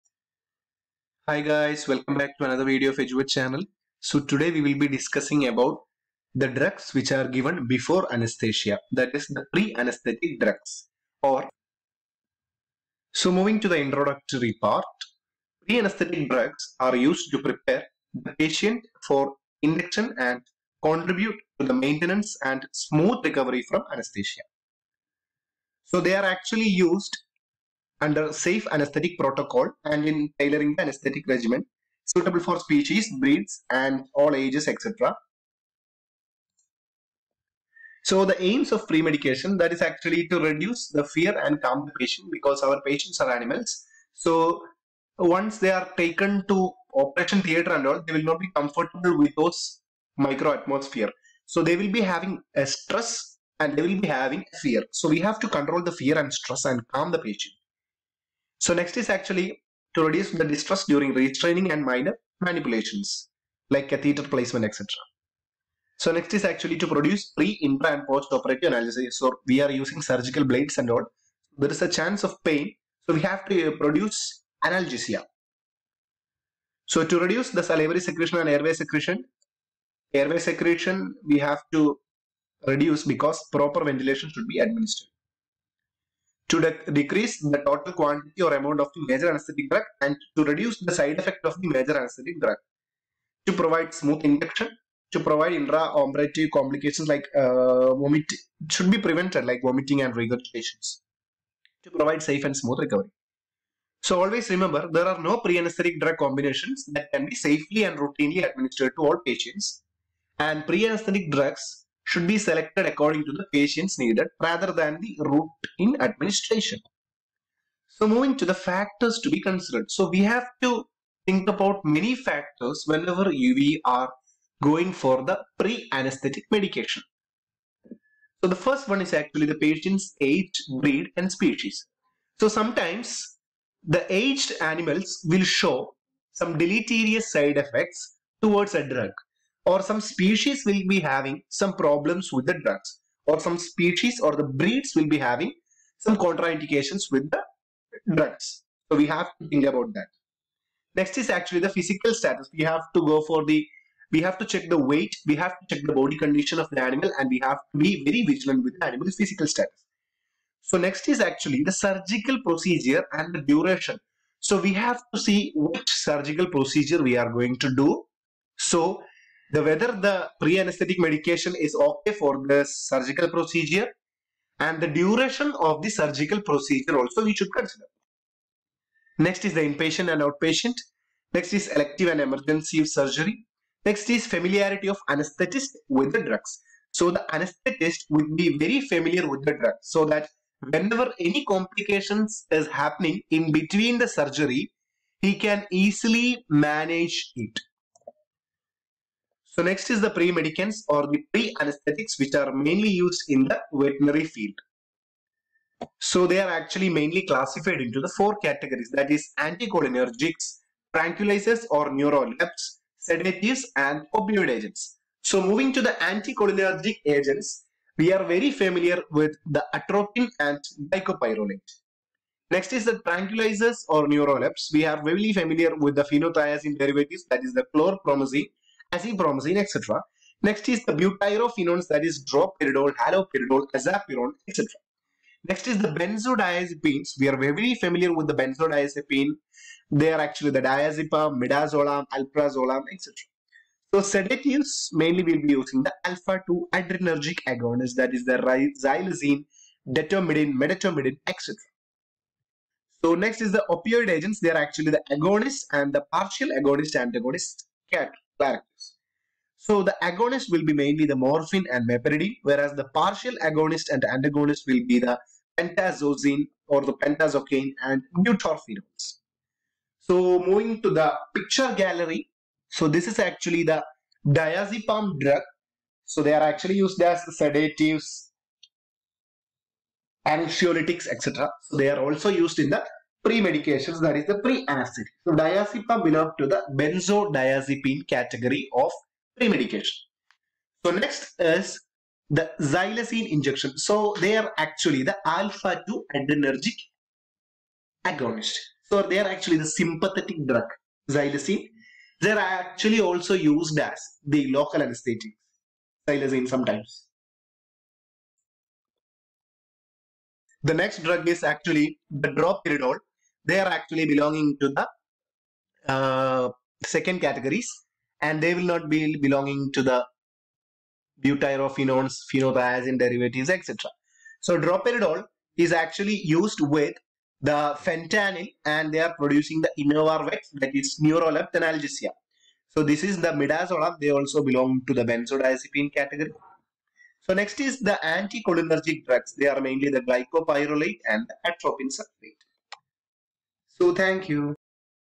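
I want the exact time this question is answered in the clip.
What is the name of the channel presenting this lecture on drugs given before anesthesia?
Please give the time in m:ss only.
0:02.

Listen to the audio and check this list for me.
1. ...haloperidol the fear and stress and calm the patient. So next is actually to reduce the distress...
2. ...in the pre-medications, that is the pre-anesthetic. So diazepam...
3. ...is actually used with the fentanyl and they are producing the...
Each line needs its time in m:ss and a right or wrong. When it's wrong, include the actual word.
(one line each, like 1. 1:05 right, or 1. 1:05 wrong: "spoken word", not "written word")
1. 0:55 wrong: "control", not "haloperidol"
2. 4:42 right
3. 5:25 right.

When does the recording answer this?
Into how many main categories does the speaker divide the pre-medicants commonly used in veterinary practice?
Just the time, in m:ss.
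3:28.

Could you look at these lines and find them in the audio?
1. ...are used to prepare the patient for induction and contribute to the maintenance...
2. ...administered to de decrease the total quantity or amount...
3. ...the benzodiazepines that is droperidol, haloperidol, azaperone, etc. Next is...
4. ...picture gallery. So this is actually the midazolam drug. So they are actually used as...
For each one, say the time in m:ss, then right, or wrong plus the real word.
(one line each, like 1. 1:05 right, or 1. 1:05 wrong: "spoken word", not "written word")
1. 0:16 right
2. 1:24 right
3. 3:50 wrong: "butyrophenones", not "benzodiazepines"
4. 4:31 wrong: "diazepam", not "midazolam".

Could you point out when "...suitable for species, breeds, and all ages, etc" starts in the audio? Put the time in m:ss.
0:32.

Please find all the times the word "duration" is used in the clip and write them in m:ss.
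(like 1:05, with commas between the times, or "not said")
2:43, 2:54.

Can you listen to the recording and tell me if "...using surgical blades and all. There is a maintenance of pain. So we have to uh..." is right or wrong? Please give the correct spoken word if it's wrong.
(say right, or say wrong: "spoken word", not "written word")
wrong: "chance", not "maintenance".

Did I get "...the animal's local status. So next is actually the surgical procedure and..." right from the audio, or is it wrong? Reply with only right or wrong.
wrong.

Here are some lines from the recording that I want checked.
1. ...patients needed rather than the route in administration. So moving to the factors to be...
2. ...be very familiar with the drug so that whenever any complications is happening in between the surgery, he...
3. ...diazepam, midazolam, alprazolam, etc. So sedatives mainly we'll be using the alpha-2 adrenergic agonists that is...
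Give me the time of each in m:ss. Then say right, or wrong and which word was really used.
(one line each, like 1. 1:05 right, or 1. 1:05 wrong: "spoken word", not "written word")
1. 1:53 right
2. 3:08 right
3. 4:00 right.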